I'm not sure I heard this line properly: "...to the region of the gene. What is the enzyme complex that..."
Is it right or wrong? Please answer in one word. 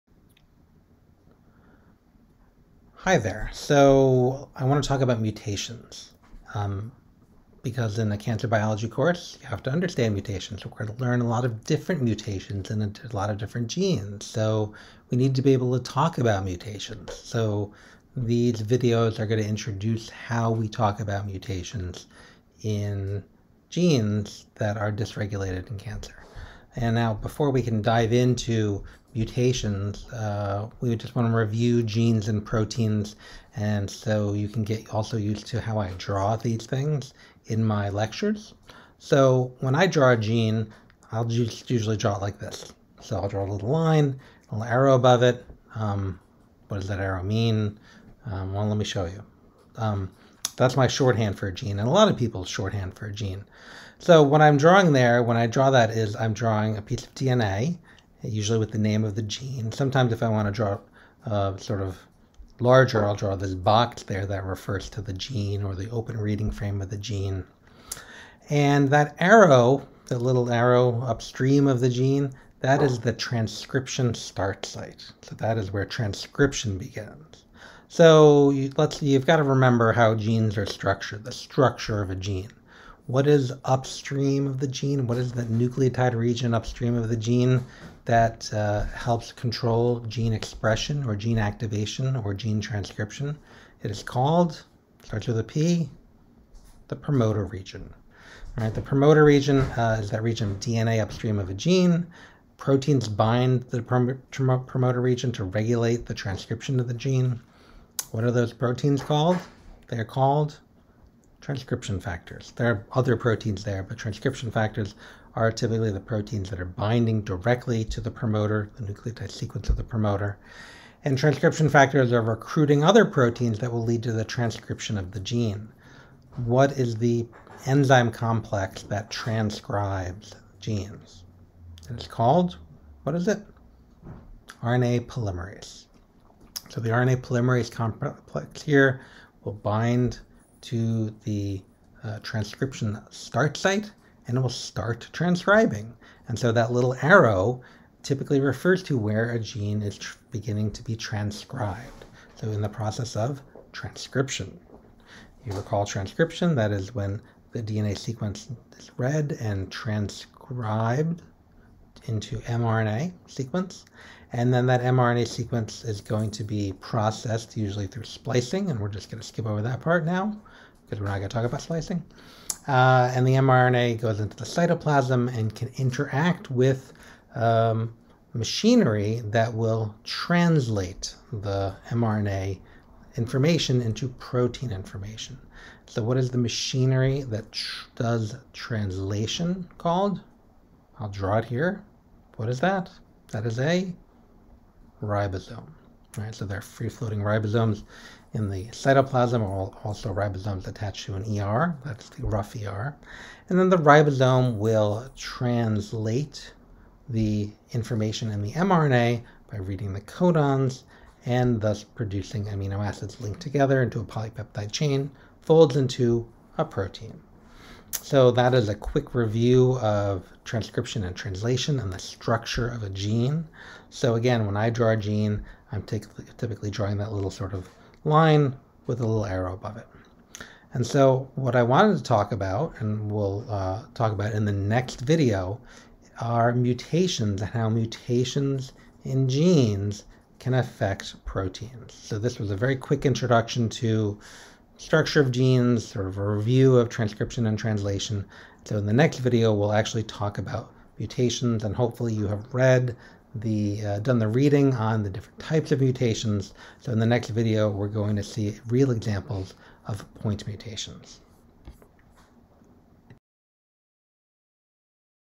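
wrong.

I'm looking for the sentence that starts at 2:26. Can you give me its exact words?
And so that little arrow typically refers to where a gene is beginning to be transcribed.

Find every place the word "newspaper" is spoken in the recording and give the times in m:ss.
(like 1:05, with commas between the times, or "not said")
not said.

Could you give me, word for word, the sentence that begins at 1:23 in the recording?
What is upstream of the gene?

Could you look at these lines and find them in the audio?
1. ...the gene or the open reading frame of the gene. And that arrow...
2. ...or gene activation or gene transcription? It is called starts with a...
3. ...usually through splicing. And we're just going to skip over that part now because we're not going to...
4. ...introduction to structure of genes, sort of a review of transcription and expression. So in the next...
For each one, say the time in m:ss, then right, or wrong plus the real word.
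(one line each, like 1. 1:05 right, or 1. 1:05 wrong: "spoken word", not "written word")
1. 1:05 right
2. 1:31 right
3. 2:47 right
4. 4:03 wrong: "translation", not "expression".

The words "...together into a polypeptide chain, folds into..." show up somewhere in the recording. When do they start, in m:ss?
3:33.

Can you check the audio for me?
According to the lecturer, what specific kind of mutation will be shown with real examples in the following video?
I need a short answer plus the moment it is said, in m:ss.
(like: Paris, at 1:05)
Point mutations, at 4:20.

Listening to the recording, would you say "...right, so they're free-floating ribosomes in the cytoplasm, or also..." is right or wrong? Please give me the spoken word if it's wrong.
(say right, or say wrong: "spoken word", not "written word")
right.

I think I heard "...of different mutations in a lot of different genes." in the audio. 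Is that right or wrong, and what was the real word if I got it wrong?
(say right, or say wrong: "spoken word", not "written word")
right.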